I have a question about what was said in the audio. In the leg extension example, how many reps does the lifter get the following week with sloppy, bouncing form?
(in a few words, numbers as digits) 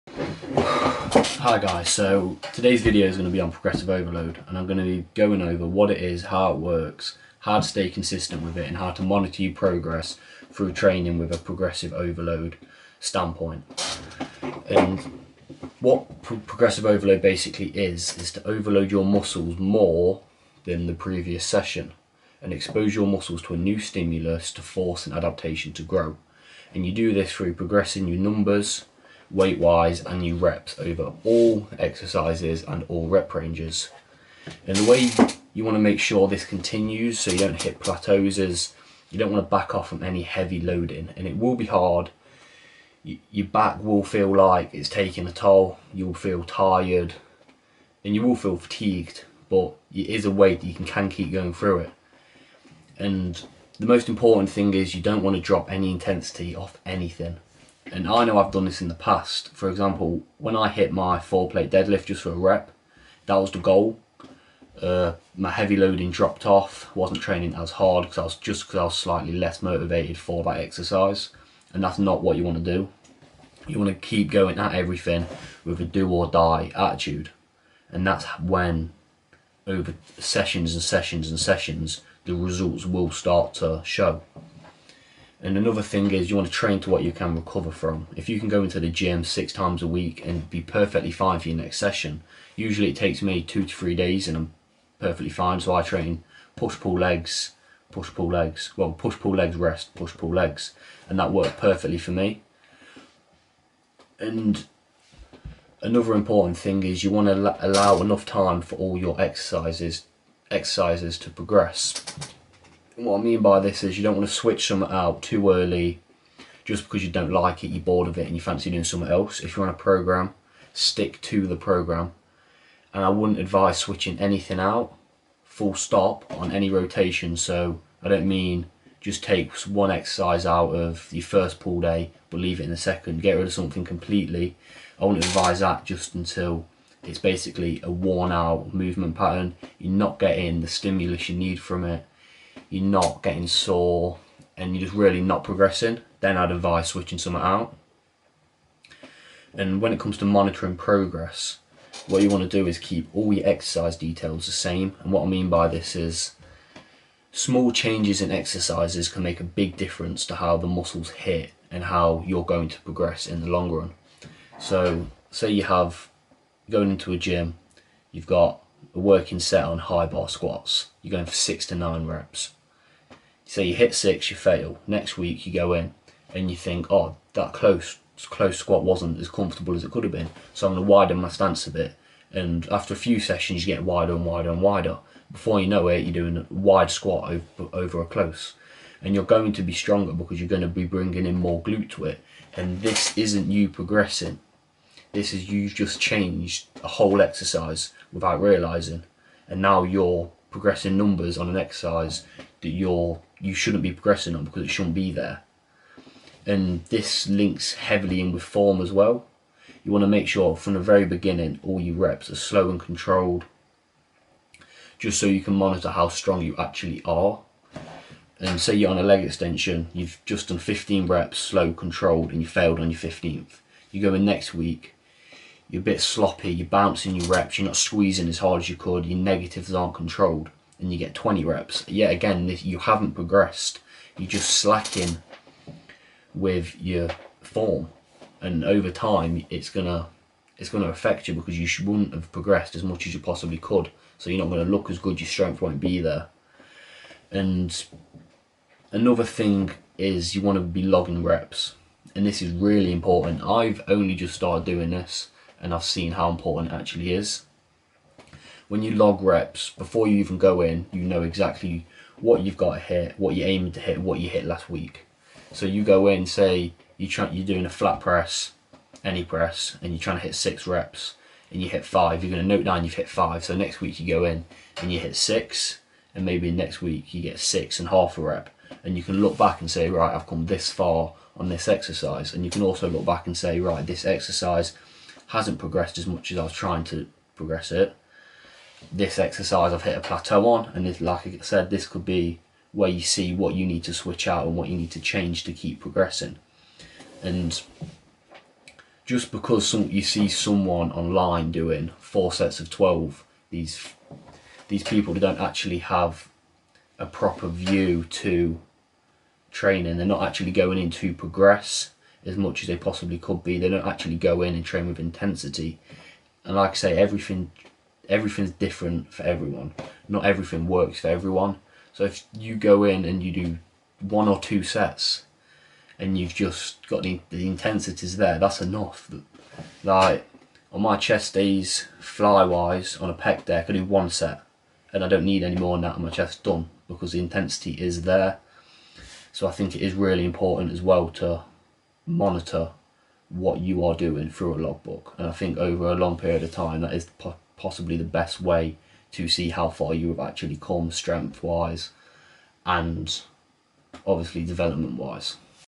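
20.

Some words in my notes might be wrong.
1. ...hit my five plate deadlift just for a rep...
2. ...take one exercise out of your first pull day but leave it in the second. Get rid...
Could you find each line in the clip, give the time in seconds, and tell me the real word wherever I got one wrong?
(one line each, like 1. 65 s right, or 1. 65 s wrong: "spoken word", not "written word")
1. 60 s wrong: "four", not "five"
2. 129 s right.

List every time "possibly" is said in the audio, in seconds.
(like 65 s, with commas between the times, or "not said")
243 s, 312 s, 347 s.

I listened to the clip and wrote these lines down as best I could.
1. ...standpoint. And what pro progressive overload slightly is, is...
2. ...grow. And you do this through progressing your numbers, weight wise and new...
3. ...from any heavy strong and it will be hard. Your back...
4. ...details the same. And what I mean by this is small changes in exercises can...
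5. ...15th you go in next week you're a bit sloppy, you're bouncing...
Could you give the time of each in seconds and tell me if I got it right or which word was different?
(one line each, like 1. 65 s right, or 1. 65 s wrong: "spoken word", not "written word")
1. 12 s wrong: "basically", not "slightly"
2. 25 s right
3. 39 s wrong: "loading", not "strong"
4. 153 s right
5. 222 s right.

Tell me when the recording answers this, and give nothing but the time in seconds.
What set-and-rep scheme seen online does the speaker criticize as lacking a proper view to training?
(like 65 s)
301 s.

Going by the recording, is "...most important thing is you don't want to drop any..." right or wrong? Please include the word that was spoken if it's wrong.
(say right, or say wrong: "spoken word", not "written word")
right.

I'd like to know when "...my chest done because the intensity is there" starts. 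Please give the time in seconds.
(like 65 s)
336 s.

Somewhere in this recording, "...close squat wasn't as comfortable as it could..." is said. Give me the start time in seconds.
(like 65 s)
178 s.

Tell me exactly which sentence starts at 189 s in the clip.
And you're going to be stronger because you're going to be bringing in more glute to it.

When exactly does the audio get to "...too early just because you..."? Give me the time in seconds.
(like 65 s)
115 s.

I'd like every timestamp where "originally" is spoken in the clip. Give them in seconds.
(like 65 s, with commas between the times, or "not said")
not said.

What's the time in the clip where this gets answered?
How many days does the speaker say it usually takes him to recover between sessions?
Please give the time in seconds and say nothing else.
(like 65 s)
93 s.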